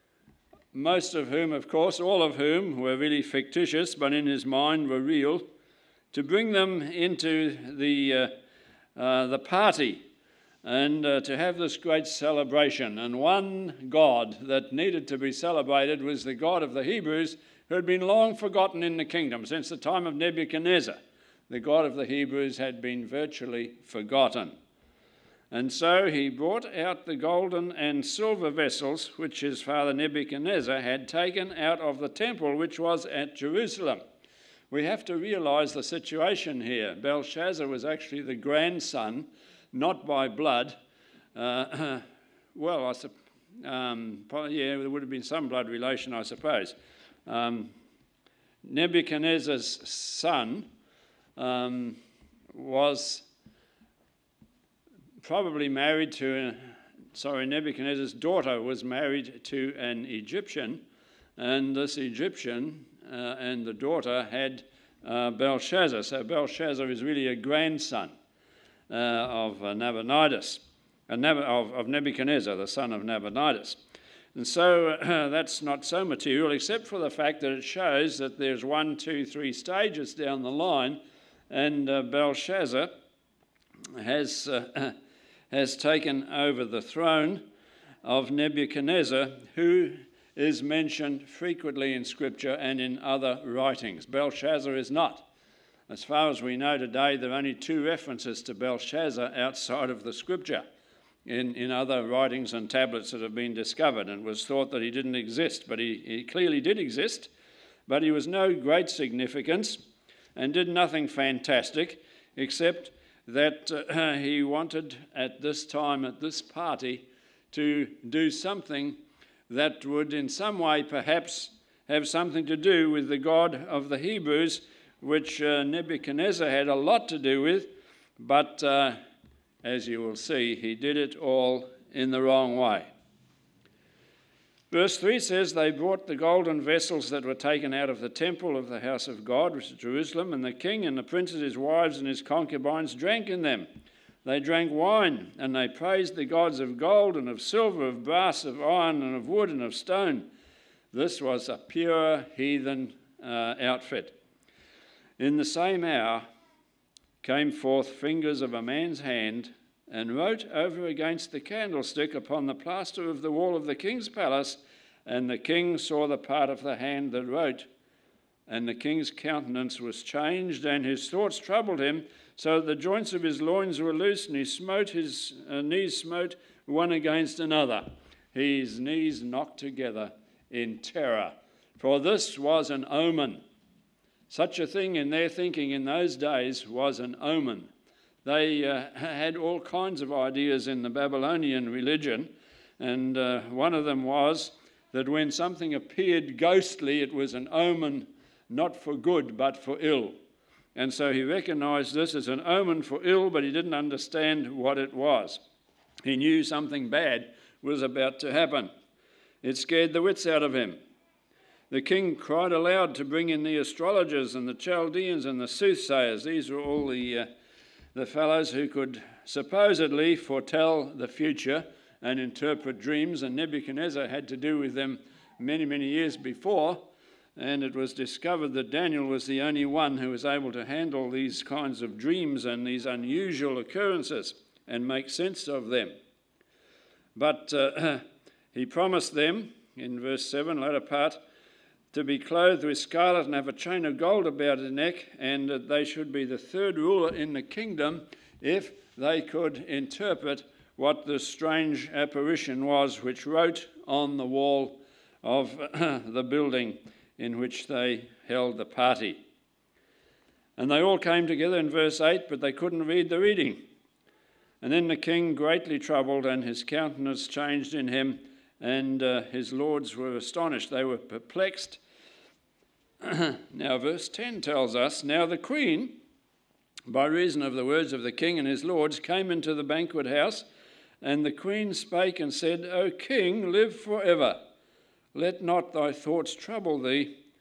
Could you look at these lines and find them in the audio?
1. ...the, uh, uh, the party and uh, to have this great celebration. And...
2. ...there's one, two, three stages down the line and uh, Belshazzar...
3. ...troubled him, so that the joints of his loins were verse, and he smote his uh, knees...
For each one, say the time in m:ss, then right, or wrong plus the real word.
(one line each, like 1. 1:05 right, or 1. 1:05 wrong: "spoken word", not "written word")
1. 0:07 right
2. 1:18 right
3. 2:51 wrong: "loose", not "verse".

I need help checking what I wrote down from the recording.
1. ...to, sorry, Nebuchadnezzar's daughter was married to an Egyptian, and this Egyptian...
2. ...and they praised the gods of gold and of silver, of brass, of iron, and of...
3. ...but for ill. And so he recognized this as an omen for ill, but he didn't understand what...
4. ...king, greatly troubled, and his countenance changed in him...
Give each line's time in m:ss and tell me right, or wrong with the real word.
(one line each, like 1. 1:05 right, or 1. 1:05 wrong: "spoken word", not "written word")
1. 0:56 right
2. 2:25 right
3. 3:19 right
4. 4:24 right.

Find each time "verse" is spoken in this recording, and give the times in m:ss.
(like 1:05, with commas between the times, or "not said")
2:14, 3:59, 4:21, 4:33.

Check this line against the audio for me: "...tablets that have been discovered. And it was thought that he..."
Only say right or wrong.
right.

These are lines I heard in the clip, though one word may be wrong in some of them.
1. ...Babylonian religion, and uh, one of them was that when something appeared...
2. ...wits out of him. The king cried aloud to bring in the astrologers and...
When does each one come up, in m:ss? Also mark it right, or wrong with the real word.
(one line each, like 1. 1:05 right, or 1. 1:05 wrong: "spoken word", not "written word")
1. 3:10 right
2. 3:30 right.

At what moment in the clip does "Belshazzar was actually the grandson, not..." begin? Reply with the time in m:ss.
0:37.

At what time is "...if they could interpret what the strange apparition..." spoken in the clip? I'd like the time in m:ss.
4:08.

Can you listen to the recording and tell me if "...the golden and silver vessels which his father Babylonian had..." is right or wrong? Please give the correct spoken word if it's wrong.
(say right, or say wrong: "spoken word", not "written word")
wrong: "Nebuchadnezzar", not "Babylonian".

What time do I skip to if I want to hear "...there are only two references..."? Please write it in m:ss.
1:37.